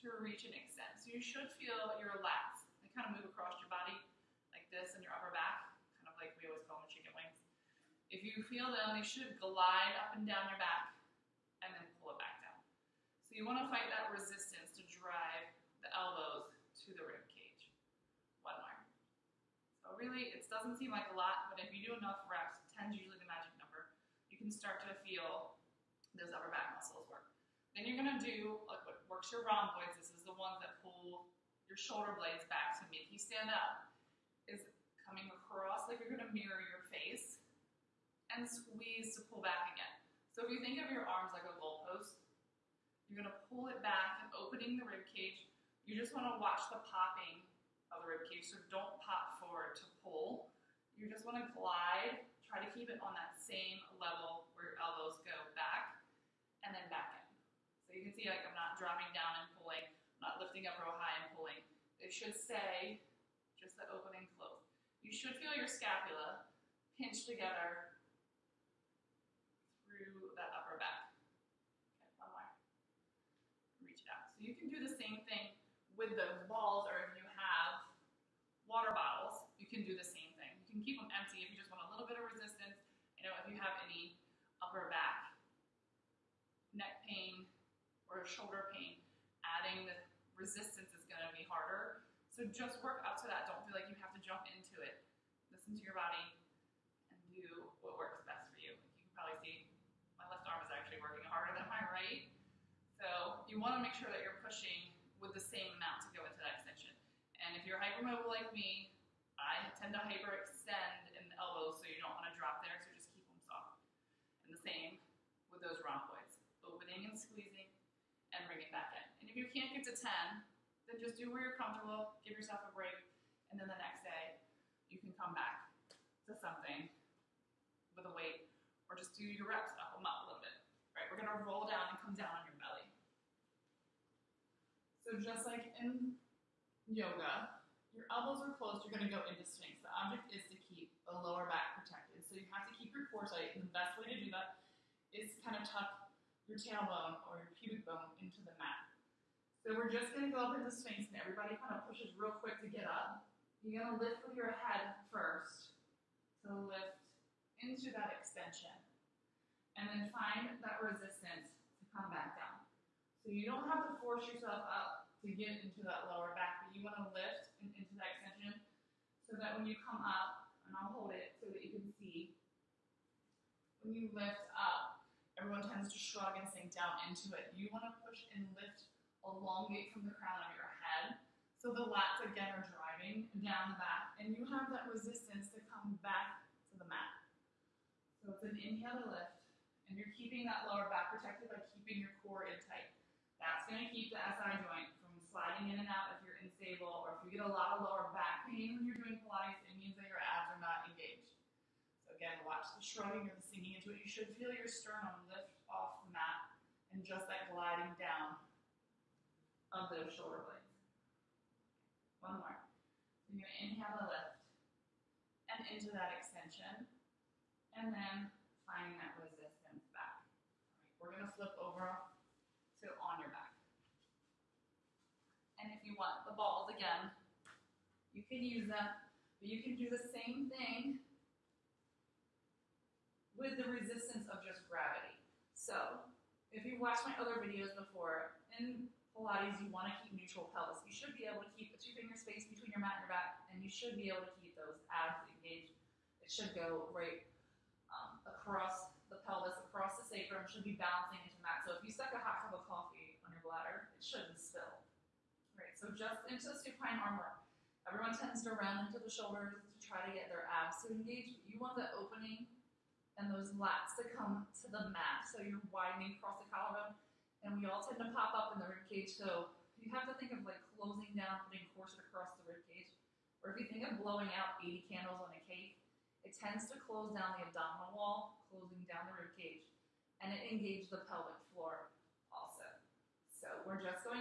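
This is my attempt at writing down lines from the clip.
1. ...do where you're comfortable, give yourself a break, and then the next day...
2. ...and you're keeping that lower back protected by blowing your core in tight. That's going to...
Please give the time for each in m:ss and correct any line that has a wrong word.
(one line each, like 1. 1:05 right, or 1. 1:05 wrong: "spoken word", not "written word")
1. 2:01 right
2. 3:09 wrong: "keeping", not "blowing".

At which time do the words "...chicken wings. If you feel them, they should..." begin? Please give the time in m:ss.
0:06.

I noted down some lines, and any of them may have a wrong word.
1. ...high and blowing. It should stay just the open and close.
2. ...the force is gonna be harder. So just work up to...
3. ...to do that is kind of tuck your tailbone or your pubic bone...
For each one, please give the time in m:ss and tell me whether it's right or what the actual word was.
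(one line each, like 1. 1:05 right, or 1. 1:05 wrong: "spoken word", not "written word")
1. 1:00 wrong: "pulling", not "blowing"
2. 1:29 wrong: "resistance", not "force"
3. 2:24 right.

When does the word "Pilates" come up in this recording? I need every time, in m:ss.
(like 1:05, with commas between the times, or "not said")
3:19, 3:59.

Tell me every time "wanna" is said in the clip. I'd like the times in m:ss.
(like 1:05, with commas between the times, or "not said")
0:46, 0:51, 1:43.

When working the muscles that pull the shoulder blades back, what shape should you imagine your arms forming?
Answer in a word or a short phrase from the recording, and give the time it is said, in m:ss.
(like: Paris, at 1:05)
a goalpost, at 0:41.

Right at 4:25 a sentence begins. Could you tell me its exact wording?
So you're widening across the collarbone, and we all tend to pop up in the rib cage.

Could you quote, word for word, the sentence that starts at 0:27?
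Then you're gonna do like what works your rhomboids.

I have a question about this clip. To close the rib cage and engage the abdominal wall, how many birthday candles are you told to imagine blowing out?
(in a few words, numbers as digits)
80.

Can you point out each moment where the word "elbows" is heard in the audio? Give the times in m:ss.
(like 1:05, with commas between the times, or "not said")
0:15, 0:54, 1:51, 2:18.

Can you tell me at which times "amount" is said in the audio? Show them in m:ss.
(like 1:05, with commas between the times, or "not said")
1:45.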